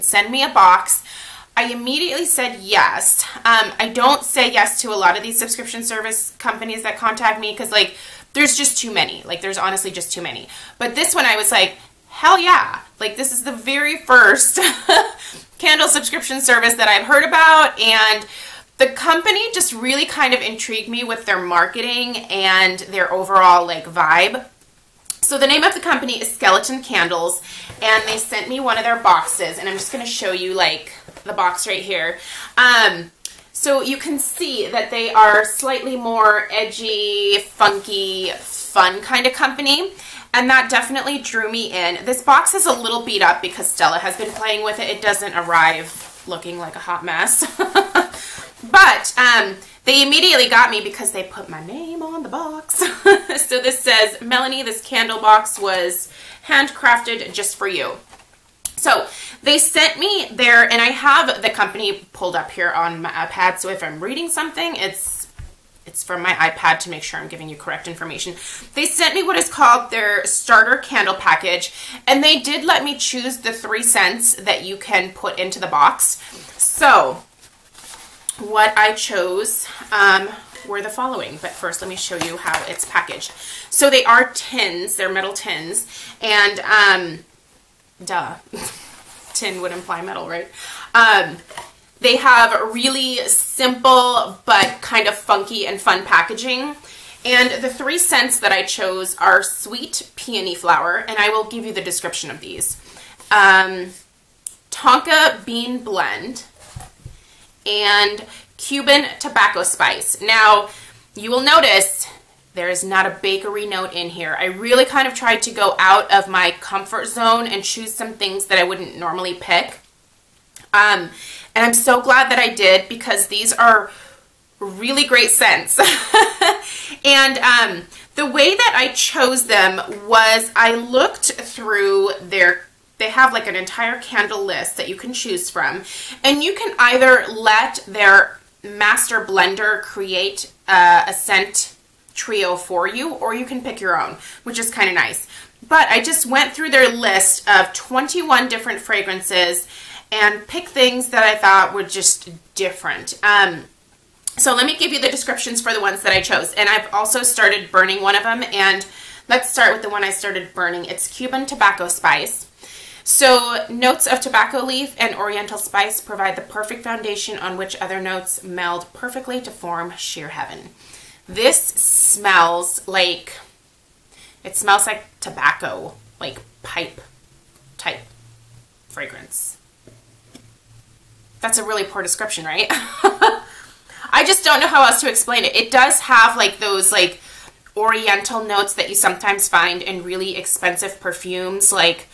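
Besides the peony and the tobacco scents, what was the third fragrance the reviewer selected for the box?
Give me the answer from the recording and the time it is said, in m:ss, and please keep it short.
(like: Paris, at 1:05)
Tonka bean blend, at 1:44.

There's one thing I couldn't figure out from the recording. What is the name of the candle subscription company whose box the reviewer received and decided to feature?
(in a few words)
Skeleton Candles.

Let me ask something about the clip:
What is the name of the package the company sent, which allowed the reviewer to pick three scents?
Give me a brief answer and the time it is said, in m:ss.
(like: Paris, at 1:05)
starter candle package, at 1:10.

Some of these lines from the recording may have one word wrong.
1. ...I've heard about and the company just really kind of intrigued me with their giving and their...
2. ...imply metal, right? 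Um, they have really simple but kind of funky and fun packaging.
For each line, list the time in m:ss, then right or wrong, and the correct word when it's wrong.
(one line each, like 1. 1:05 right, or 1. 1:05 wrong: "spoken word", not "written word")
1. 0:16 wrong: "marketing", not "giving"
2. 1:29 right.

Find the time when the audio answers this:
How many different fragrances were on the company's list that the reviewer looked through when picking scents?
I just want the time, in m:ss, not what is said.
2:27.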